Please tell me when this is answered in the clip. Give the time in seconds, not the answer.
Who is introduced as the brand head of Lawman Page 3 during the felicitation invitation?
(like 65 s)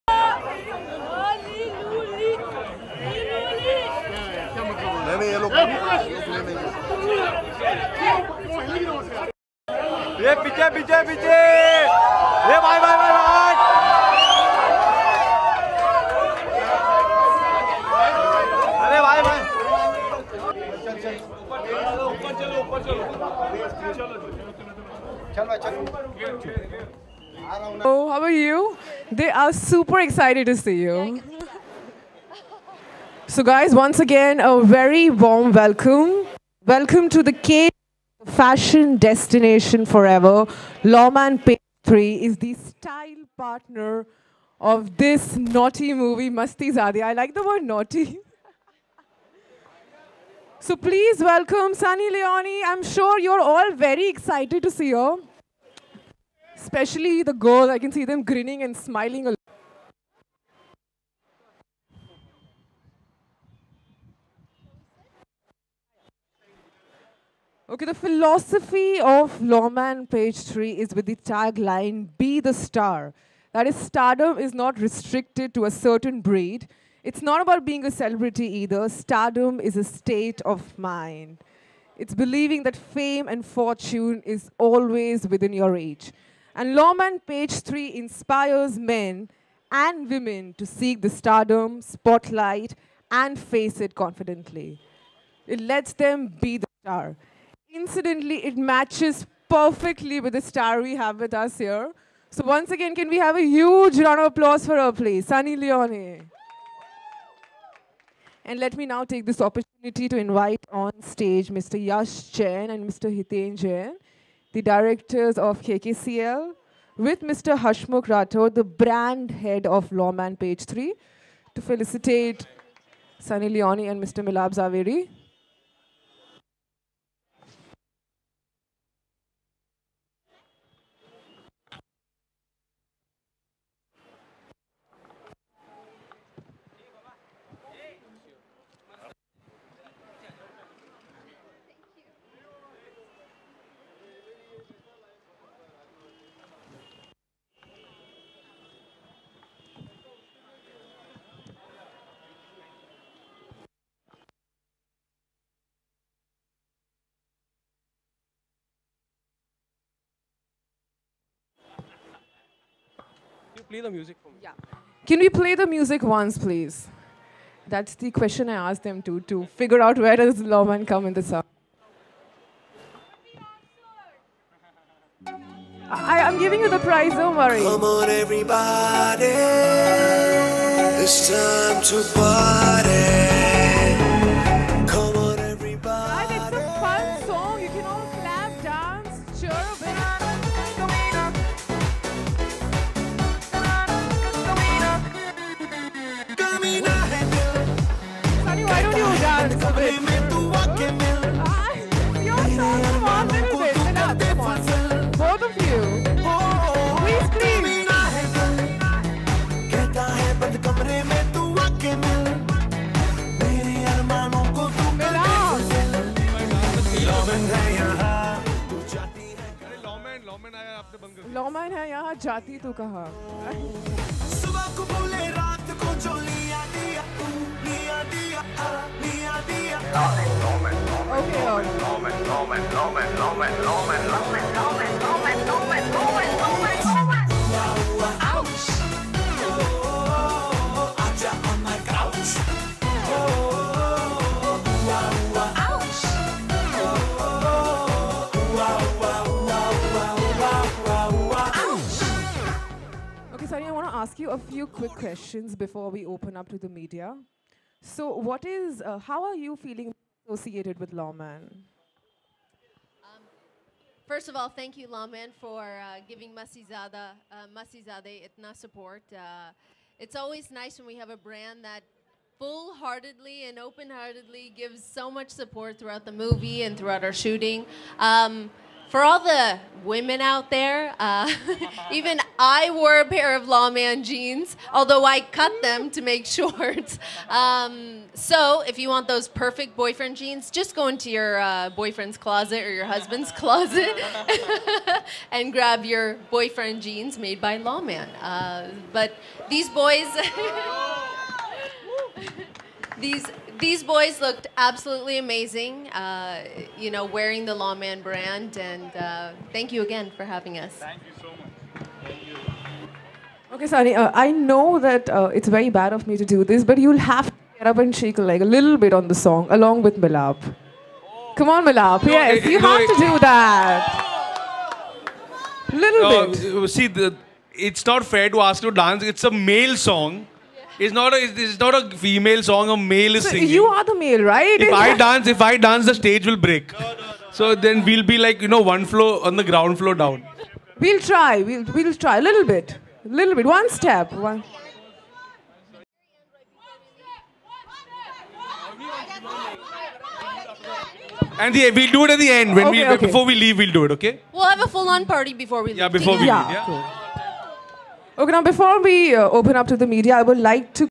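117 s.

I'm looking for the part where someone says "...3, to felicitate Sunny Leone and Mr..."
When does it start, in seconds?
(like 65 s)
120 s.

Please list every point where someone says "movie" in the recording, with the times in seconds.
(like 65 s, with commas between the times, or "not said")
46 s, 276 s.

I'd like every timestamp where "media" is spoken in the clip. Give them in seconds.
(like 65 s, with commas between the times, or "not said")
256 s, 359 s.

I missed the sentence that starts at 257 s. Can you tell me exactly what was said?
So, what is, uh, how are you feeling associated with Lawman?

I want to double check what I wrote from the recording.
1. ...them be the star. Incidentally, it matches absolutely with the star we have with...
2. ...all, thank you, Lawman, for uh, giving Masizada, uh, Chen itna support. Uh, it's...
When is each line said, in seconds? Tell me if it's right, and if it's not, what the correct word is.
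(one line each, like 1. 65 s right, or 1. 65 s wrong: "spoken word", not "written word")
1. 95 s wrong: "perfectly", not "absolutely"
2. 264 s wrong: "Mastizaade", not "Chen".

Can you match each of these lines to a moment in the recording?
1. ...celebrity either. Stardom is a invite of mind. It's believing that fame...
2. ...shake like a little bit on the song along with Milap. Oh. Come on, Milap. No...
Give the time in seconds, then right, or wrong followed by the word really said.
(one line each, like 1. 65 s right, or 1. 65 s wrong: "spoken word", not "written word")
1. 77 s wrong: "state", not "invite"
2. 317 s right.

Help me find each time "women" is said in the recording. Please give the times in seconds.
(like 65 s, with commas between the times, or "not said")
90 s, 279 s.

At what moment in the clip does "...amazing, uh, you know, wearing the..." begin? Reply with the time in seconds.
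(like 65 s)
305 s.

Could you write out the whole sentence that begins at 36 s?
Welcome to the K fashion destination forever.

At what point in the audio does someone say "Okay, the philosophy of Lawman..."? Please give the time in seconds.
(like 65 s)
67 s.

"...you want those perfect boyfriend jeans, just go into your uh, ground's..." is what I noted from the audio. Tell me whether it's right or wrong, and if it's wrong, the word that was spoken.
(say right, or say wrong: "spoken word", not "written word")
wrong: "boyfriend", not "ground".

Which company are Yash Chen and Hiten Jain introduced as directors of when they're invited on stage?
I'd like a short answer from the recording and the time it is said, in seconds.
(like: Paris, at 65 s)
KKCL, at 115 s.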